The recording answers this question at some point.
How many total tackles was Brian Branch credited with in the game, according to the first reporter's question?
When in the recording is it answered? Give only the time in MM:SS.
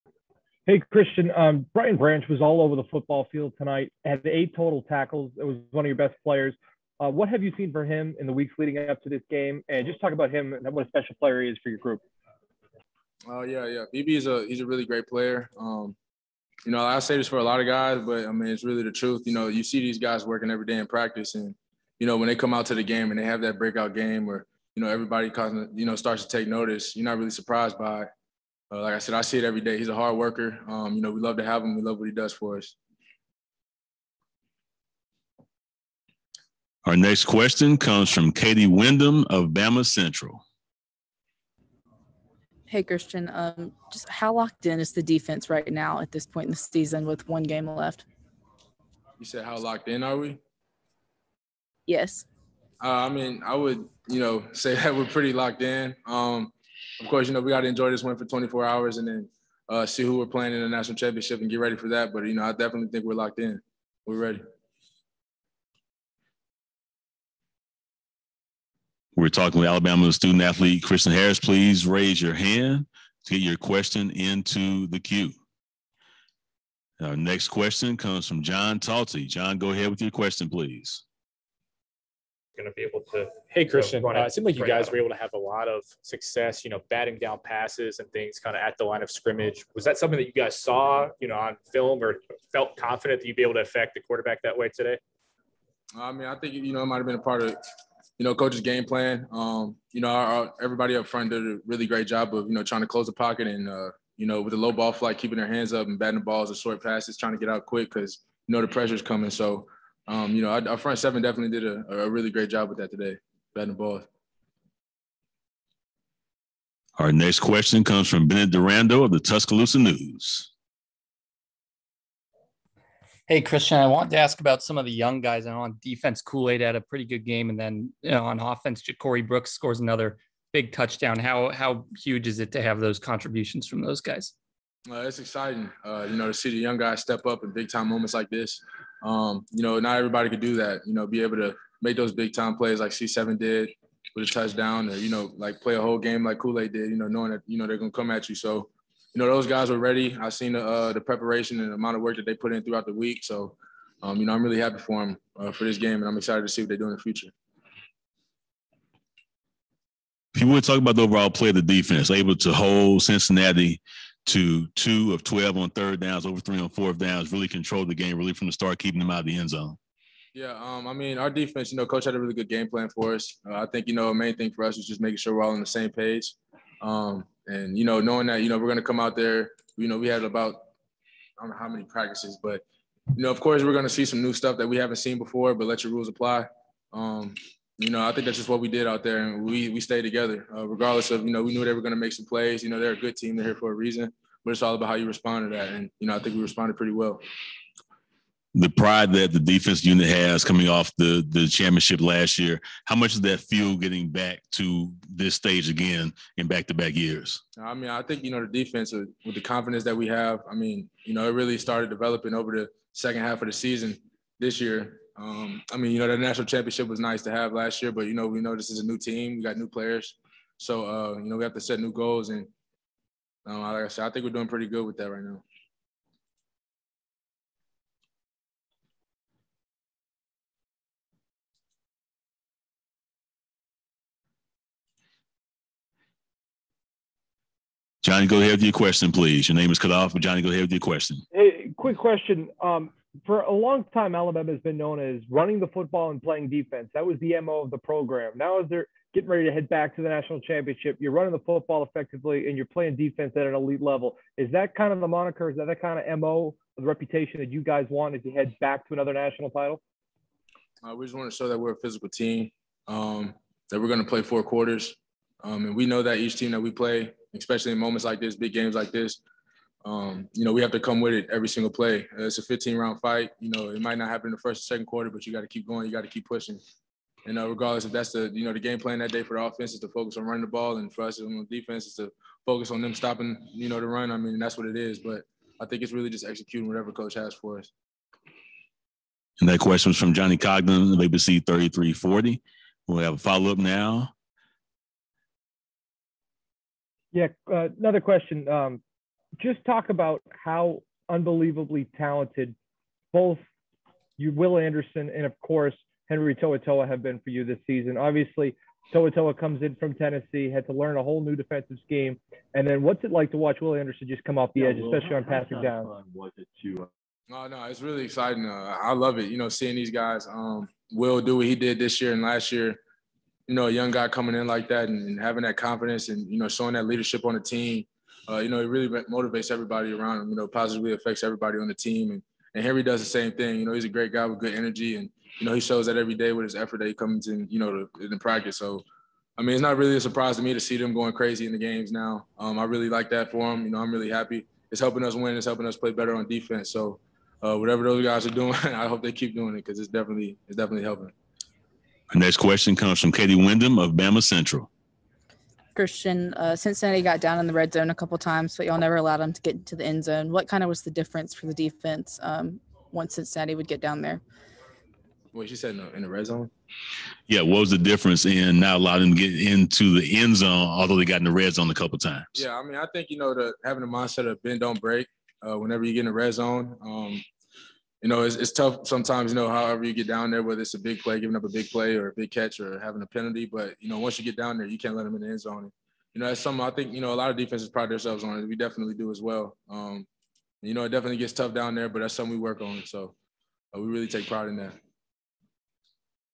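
00:04.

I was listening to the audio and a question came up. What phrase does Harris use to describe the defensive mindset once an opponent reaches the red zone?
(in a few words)
Bend don't break.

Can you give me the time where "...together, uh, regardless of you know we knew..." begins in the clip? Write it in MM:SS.
03:10.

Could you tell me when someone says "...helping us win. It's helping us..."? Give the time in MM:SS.
05:44.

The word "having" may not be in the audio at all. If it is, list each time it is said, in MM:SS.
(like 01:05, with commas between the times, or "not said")
05:25, 06:13, 06:22.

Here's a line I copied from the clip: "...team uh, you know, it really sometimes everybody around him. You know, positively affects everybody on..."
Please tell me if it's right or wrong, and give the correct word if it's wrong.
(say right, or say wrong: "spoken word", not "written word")
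wrong: "motivates", not "sometimes".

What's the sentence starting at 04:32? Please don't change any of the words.
Uh, it's a 15 round fight.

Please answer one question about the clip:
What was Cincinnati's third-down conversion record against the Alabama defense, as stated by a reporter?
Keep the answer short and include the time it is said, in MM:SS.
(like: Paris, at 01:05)
2 of 12, at 02:44.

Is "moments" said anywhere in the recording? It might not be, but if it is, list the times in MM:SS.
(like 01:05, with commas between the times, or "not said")
02:17, 04:27.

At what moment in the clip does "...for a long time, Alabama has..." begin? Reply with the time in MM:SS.
04:03.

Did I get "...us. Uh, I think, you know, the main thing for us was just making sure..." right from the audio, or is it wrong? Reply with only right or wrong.
right.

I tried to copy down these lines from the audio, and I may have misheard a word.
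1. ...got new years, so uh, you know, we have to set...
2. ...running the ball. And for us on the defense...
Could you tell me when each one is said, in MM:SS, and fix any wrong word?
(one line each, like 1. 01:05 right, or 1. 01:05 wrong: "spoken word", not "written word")
1. 03:39 wrong: "players", not "years"
2. 04:40 right.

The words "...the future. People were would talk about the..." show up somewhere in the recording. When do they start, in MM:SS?
02:36.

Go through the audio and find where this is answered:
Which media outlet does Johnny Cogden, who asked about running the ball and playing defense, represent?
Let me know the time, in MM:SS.
04:50.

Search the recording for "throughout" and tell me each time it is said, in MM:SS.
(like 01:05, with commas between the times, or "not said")
02:32.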